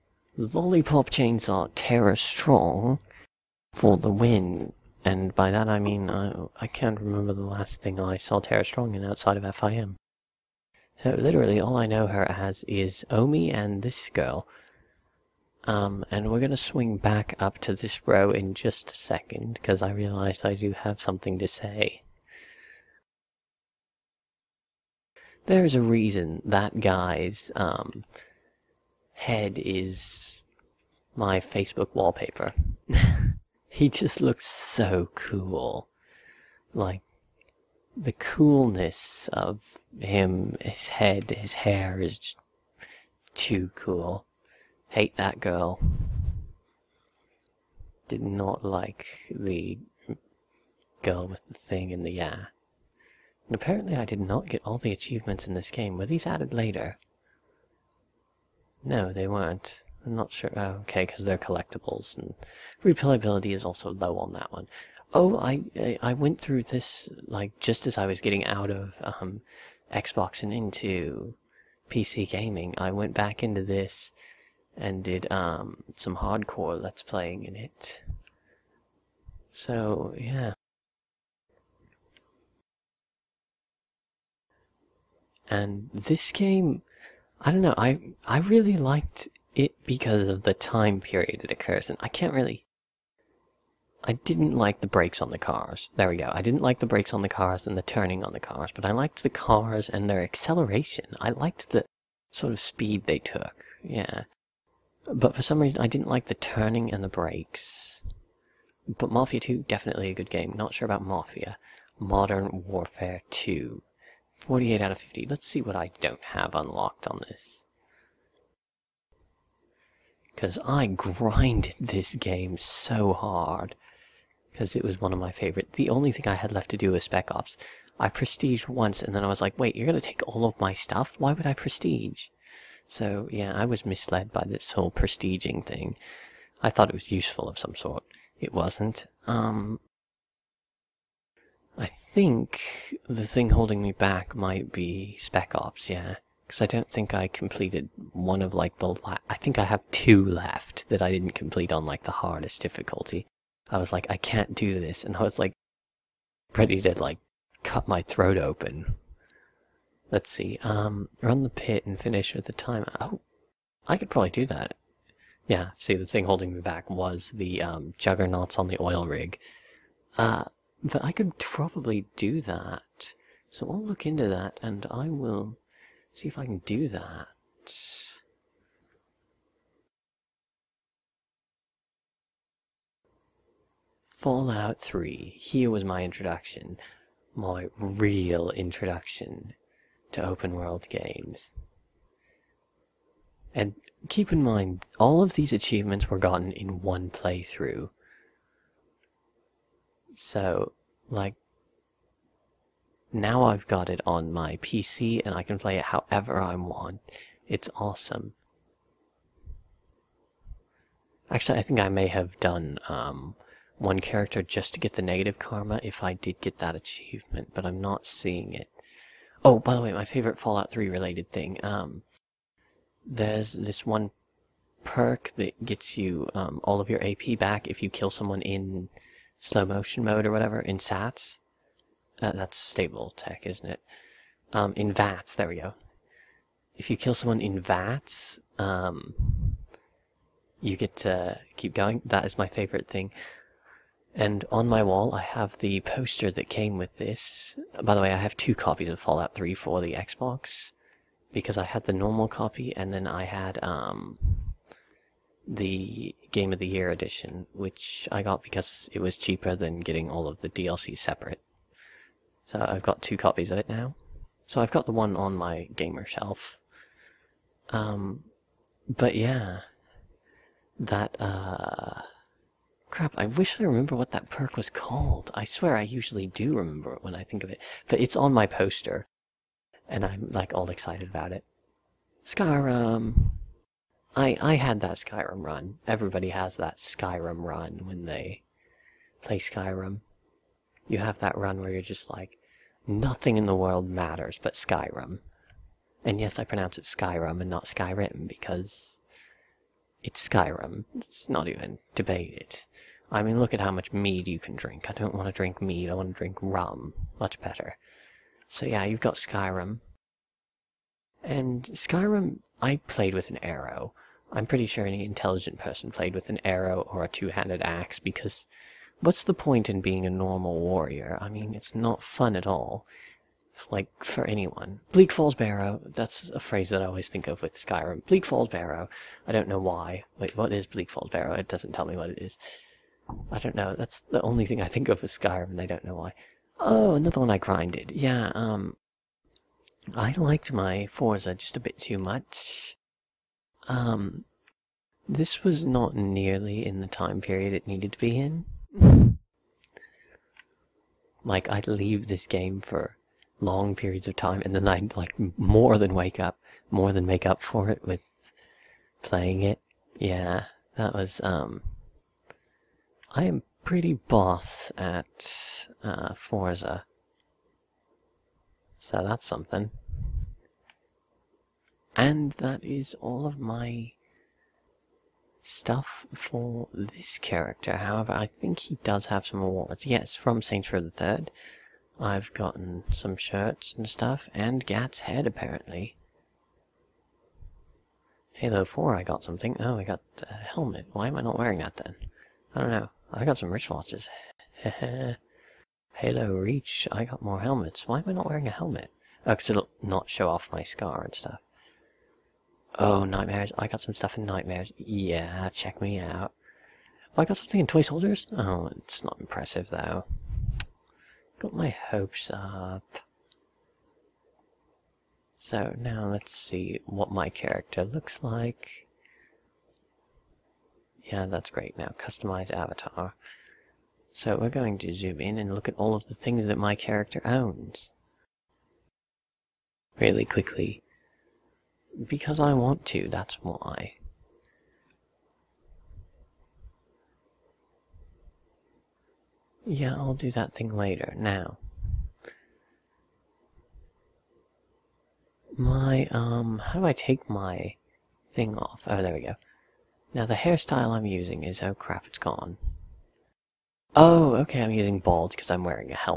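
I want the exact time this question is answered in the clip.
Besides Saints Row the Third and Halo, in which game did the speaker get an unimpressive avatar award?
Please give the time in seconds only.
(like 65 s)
407 s.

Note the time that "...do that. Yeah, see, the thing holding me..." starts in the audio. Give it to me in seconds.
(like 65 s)
164 s.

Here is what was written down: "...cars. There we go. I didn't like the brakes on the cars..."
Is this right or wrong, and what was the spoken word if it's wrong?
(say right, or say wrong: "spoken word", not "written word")
right.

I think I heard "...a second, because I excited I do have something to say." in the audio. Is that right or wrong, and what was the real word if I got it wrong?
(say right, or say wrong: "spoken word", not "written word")
wrong: "realized", not "excited".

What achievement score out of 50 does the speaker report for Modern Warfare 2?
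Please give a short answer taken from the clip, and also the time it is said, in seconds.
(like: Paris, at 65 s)
48, at 114 s.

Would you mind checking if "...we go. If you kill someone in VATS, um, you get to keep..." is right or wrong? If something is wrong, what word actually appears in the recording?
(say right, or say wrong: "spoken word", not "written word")
right.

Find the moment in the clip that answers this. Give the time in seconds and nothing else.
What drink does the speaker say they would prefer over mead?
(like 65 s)
306 s.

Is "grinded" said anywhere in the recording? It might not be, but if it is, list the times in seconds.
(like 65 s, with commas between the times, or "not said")
120 s, 337 s.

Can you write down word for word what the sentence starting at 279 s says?
And I'm like all excited about it.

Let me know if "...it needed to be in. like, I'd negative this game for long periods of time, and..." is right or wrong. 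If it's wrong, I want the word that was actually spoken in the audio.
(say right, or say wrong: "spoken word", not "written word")
wrong: "leave", not "negative".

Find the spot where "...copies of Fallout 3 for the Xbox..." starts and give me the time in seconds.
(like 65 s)
248 s.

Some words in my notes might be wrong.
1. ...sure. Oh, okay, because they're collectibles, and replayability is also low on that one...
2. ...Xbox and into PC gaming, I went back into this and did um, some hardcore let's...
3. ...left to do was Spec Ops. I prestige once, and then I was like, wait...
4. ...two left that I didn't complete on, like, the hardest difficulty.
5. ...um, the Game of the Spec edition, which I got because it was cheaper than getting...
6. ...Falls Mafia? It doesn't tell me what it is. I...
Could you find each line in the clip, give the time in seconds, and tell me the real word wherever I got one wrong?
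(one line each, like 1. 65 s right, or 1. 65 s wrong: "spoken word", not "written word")
1. 60 s right
2. 69 s right
3. 126 s right
4. 149 s right
5. 253 s wrong: "Year", not "Spec"
6. 330 s wrong: "Barrow", not "Mafia".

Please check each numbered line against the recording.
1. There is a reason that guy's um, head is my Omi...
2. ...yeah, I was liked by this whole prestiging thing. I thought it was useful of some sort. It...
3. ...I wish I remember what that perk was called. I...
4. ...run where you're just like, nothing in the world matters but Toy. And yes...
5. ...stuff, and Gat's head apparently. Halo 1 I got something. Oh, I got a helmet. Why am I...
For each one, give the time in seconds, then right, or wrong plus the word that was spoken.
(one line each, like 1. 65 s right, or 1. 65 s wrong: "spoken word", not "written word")
1. 25 s wrong: "Facebook", not "Omi"
2. 133 s wrong: "misled", not "liked"
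3. 273 s right
4. 291 s wrong: "Skyrim", not "Toy"
5. 383 s wrong: "4", not "1".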